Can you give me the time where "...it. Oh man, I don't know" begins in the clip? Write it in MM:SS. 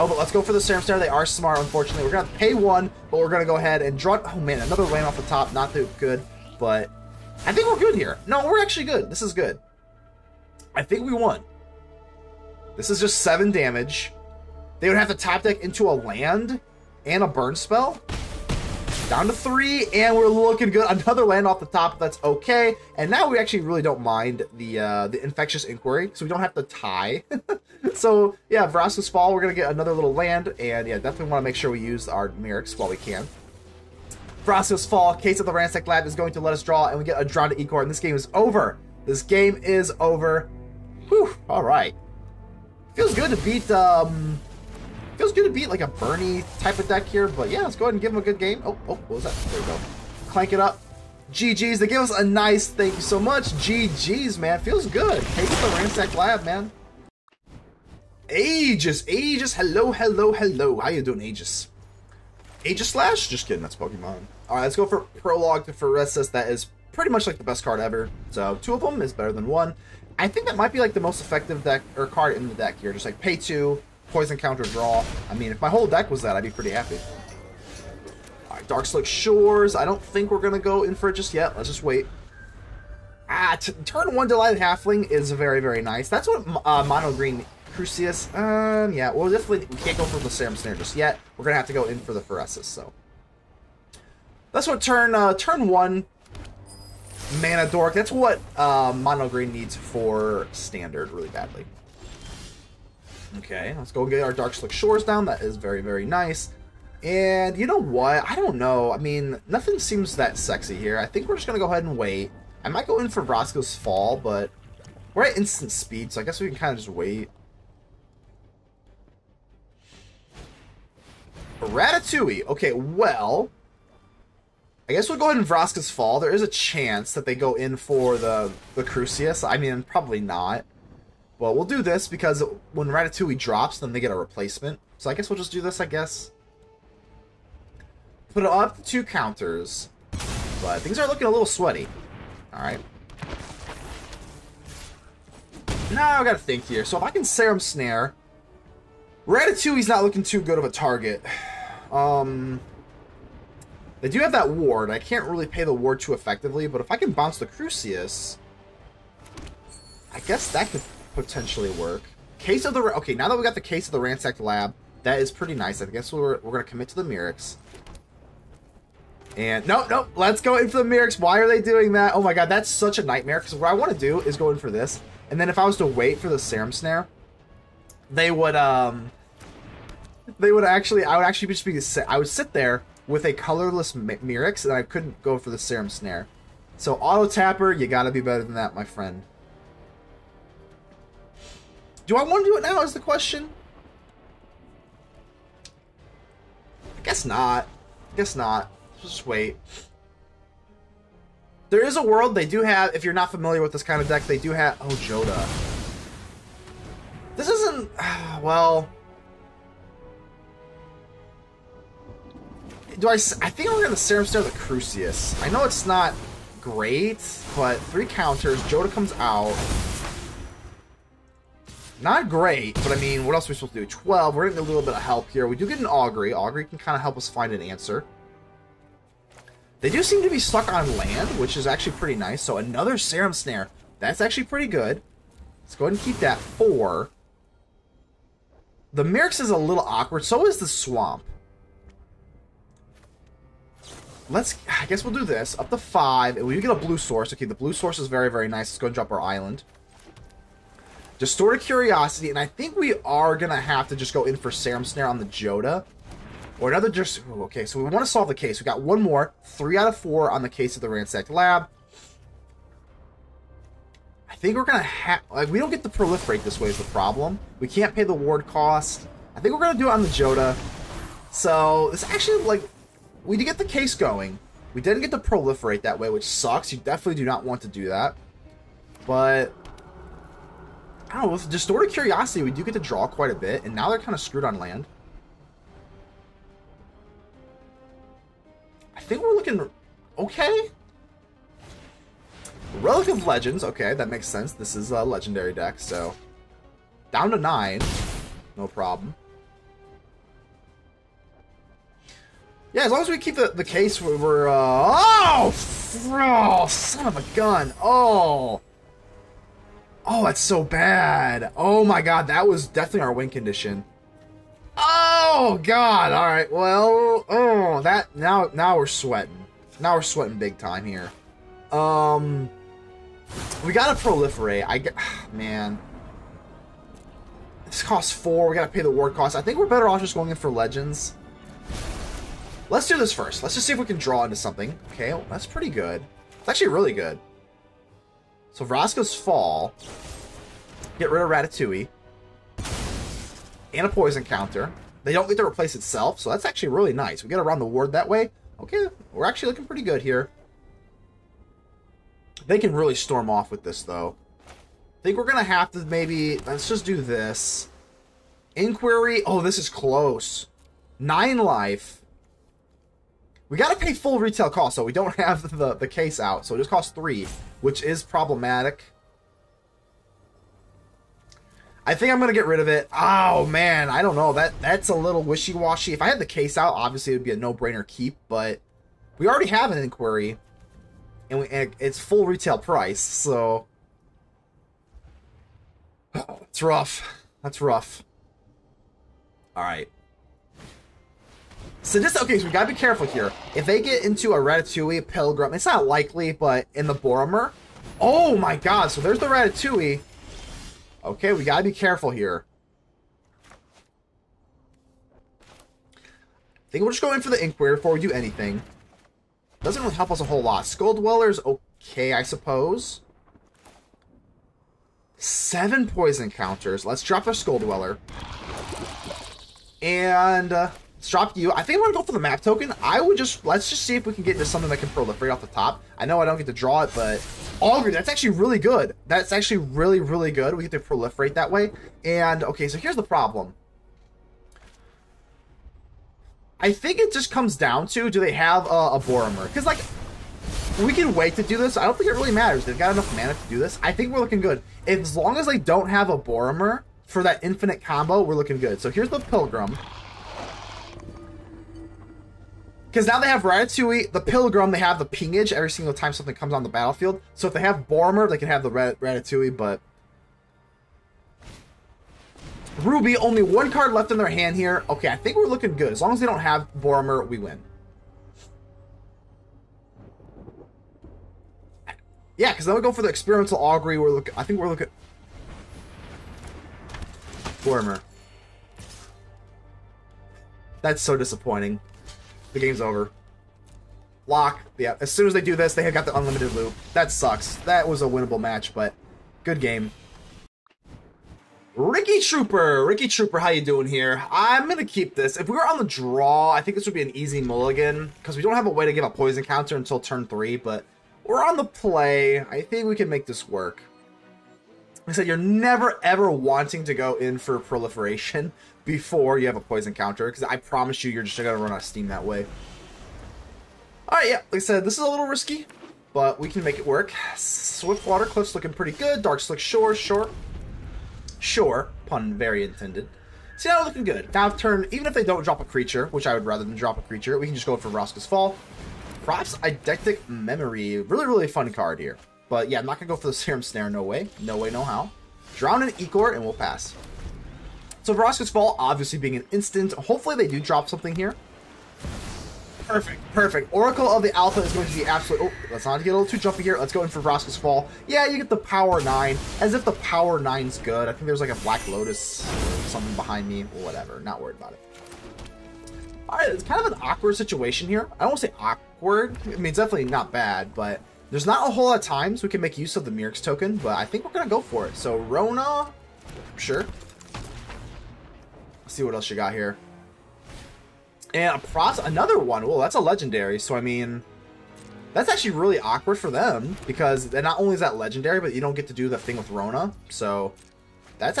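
06:12.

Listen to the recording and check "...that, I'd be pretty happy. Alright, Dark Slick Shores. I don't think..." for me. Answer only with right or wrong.
right.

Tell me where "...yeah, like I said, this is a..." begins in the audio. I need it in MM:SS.
08:34.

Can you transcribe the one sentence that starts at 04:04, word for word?
Let's, I guess we'll do this.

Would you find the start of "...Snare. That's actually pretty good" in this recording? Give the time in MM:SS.
03:53.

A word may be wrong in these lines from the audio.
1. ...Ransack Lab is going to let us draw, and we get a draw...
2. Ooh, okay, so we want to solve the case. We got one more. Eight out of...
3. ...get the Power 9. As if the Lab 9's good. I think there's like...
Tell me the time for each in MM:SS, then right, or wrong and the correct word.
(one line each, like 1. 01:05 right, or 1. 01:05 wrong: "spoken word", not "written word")
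1. 00:35 right
2. 04:17 wrong: "Three", not "Eight"
3. 09:08 wrong: "Power", not "Lab".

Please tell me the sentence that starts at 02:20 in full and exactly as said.
But things are looking a little sweaty.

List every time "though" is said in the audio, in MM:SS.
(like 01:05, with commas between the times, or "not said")
05:53.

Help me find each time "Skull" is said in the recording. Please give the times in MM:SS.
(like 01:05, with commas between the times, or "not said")
06:50, 06:57.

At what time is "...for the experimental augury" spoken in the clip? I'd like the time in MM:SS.
07:52.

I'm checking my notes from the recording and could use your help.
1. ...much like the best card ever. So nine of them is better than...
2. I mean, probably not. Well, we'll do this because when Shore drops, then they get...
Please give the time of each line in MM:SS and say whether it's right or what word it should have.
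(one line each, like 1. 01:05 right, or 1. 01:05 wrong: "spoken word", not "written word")
1. 01:07 wrong: "two", not "nine"
2. 02:09 wrong: "Ratatouille", not "Shore".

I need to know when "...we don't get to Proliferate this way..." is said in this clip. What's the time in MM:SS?
04:25.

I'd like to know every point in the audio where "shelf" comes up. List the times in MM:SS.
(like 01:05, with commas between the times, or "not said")
not said.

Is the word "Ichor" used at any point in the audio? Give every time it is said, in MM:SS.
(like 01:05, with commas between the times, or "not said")
00:37, 08:55.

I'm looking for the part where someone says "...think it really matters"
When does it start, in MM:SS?
07:21.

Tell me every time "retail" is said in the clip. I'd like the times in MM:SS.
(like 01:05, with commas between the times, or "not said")
06:04, 06:22.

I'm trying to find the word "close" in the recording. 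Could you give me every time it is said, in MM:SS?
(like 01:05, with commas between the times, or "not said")
05:59.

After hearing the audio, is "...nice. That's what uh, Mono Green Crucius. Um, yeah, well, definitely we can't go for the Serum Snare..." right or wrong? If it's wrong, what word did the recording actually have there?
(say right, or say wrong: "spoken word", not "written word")
right.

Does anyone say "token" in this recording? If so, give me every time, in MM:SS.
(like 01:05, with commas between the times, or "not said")
07:02, 09:23.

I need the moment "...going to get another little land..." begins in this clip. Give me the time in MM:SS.
00:29.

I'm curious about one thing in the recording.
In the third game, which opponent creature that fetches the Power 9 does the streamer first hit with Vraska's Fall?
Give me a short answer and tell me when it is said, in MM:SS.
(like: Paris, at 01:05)
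Oracle of the Alpha, at 09:03.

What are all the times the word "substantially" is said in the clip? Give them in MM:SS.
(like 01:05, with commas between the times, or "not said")
not said.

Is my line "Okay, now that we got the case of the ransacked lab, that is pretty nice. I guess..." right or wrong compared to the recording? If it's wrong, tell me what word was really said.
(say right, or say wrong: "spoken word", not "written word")
right.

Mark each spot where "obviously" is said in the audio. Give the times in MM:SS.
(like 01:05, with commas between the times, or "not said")
06:16, 08:58.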